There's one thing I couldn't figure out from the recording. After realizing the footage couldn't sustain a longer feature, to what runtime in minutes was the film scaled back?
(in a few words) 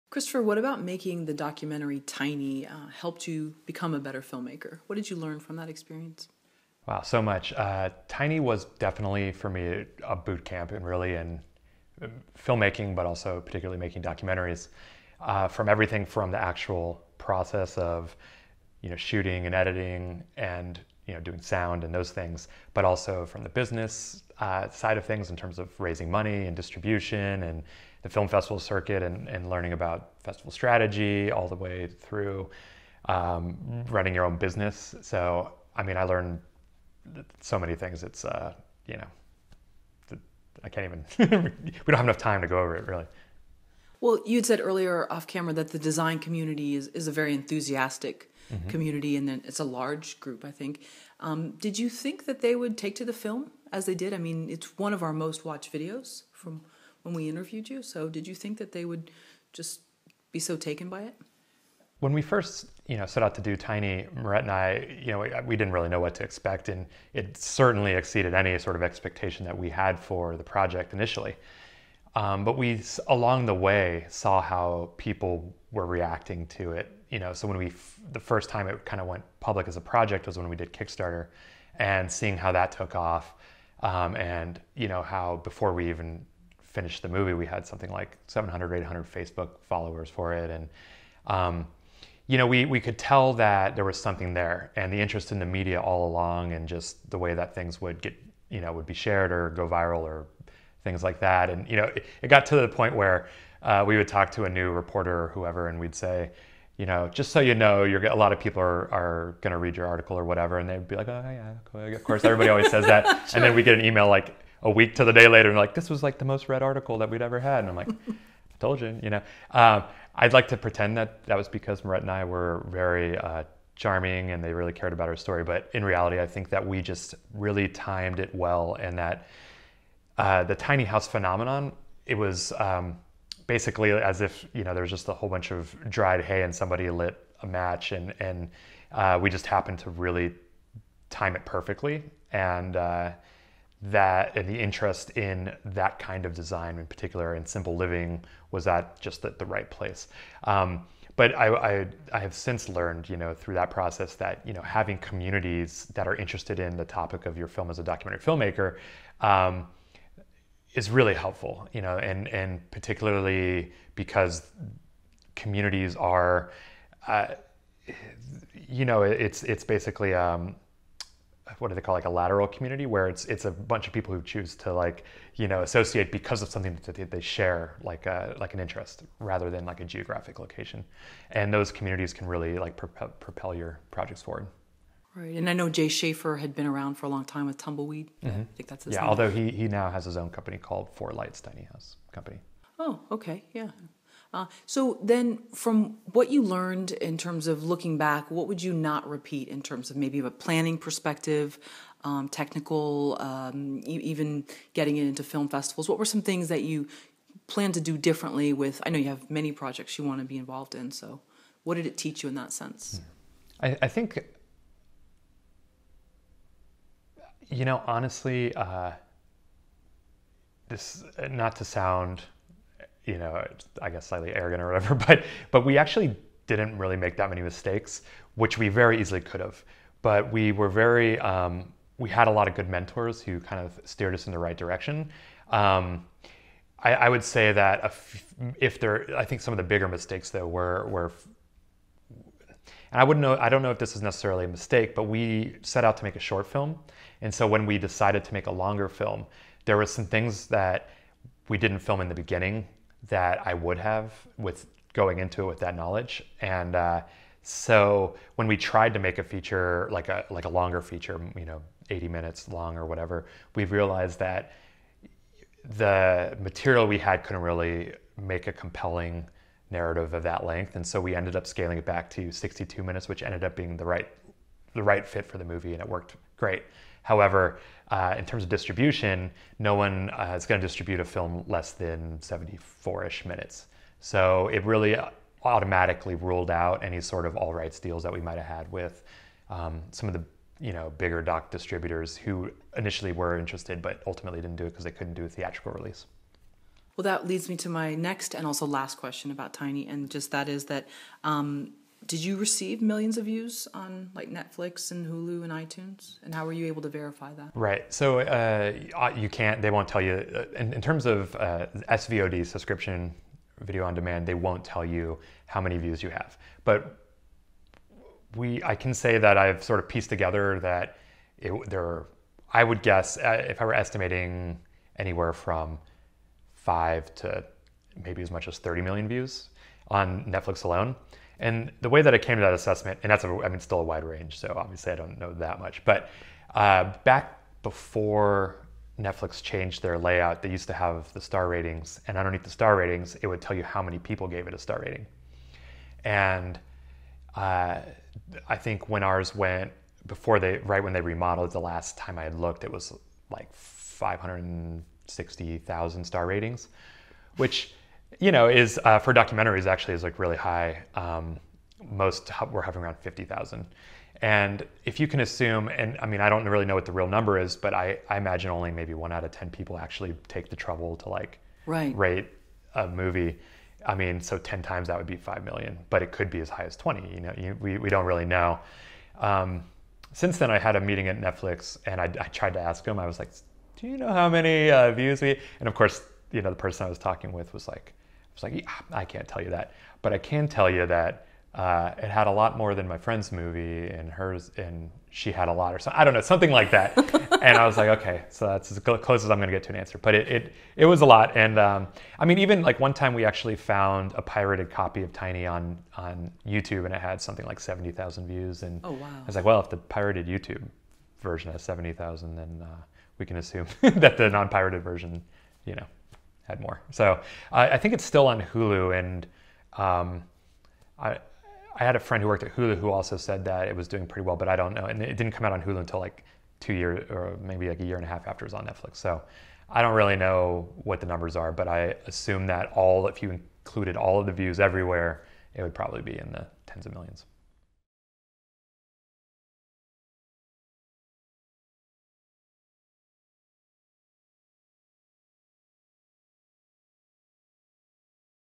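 62 minutes.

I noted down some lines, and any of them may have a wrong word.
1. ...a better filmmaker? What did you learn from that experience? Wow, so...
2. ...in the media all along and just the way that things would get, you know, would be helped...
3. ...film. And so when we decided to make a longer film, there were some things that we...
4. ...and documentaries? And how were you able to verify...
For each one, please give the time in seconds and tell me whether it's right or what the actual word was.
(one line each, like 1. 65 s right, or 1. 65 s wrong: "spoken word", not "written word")
1. 3 s right
2. 95 s wrong: "shared", not "helped"
3. 246 s right
4. 305 s wrong: "iTunes", not "documentaries".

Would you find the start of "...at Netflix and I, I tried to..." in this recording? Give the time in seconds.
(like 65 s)
381 s.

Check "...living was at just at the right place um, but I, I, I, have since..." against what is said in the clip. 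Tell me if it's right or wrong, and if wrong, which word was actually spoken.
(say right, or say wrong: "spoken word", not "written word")
right.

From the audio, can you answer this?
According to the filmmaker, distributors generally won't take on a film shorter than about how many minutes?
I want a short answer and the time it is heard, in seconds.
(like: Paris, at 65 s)
74 minutes, at 282 s.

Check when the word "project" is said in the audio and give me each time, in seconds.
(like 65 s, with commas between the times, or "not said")
70 s, 79 s, 183 s, 209 s.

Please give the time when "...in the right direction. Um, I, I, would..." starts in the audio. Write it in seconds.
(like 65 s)
234 s.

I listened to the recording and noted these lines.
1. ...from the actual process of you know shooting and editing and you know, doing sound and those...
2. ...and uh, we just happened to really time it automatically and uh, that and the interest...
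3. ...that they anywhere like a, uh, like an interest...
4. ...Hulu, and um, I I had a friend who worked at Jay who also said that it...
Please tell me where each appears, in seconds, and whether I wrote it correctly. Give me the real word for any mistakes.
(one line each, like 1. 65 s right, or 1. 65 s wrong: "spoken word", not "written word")
1. 16 s right
2. 138 s wrong: "perfectly", not "automatically"
3. 176 s wrong: "share", not "anywhere"
4. 418 s wrong: "Hulu", not "Jay".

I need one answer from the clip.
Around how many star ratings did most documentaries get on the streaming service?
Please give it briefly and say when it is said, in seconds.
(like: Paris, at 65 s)
50,000, at 362 s.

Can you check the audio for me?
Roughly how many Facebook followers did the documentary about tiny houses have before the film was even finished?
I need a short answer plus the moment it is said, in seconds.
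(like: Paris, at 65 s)
700-800, at 88 s.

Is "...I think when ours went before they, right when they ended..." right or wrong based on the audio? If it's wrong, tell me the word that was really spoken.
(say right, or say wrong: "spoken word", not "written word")
wrong: "remodeled", not "ended".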